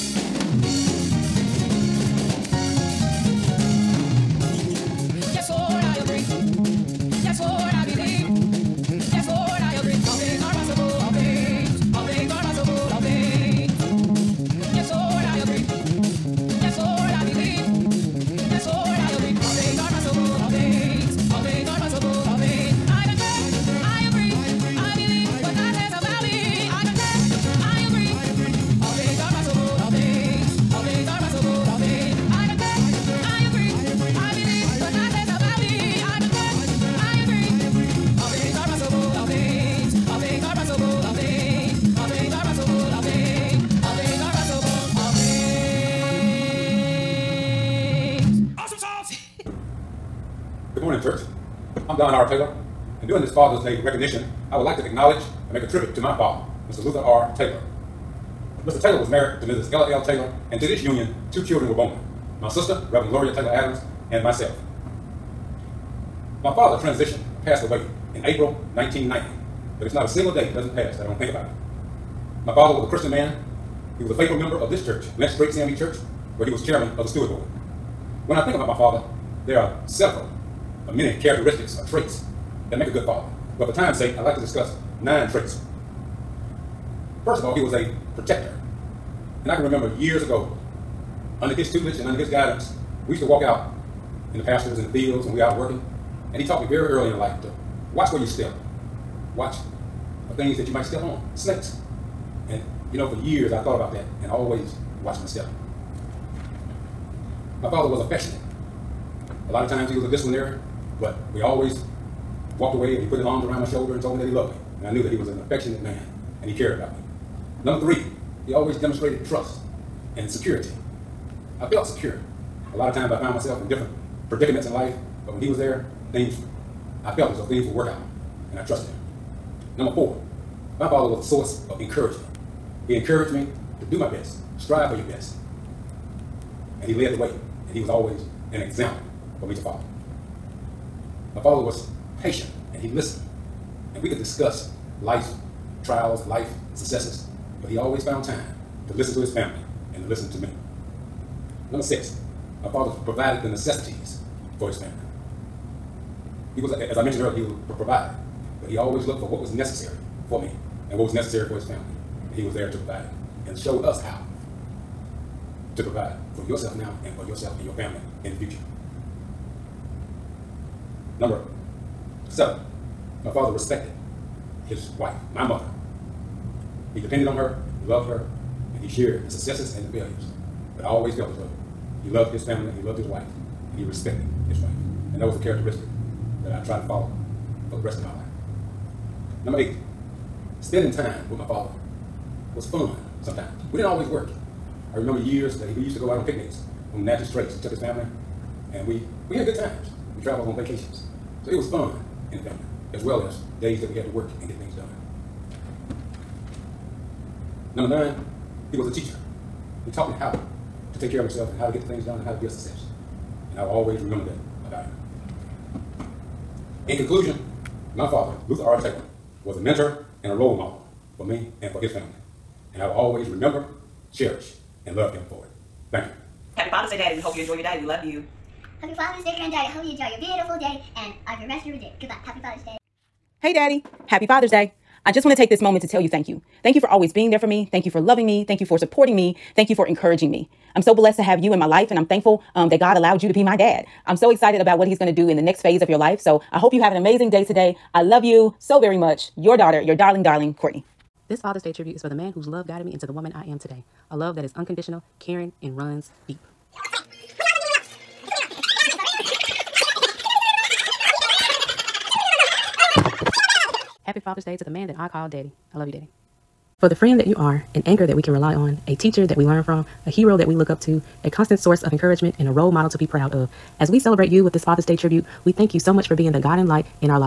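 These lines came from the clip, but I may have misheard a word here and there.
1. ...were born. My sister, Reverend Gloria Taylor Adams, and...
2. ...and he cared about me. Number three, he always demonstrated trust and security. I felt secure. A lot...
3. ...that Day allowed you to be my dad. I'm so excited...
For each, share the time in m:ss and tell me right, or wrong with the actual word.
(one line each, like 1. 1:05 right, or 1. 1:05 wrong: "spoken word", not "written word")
1. 1:01 right
2. 1:56 right
3. 4:02 wrong: "God", not "Day".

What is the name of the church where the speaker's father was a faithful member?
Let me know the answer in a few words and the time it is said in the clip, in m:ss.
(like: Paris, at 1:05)
Lynch Street CME Church, at 1:15.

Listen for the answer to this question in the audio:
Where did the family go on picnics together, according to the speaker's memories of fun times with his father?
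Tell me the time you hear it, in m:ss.
3:17.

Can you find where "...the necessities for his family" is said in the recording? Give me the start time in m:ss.
2:33.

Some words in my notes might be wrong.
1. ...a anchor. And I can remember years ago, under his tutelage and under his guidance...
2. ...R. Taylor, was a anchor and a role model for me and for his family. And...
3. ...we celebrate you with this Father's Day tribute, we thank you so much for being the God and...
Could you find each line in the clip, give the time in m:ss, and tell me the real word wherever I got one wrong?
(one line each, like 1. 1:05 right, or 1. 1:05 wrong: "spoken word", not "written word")
1. 1:27 wrong: "protector", not "anchor"
2. 3:38 wrong: "mentor", not "anchor"
3. 4:33 right.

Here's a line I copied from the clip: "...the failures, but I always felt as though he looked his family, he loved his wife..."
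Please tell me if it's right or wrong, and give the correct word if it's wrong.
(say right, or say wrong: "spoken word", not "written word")
wrong: "loved", not "looked".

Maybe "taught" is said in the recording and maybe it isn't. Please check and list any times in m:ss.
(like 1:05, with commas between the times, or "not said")
1:36, 3:29.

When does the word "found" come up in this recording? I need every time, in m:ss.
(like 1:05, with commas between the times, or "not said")
2:03, 2:28.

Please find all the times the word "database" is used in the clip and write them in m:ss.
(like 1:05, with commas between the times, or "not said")
not said.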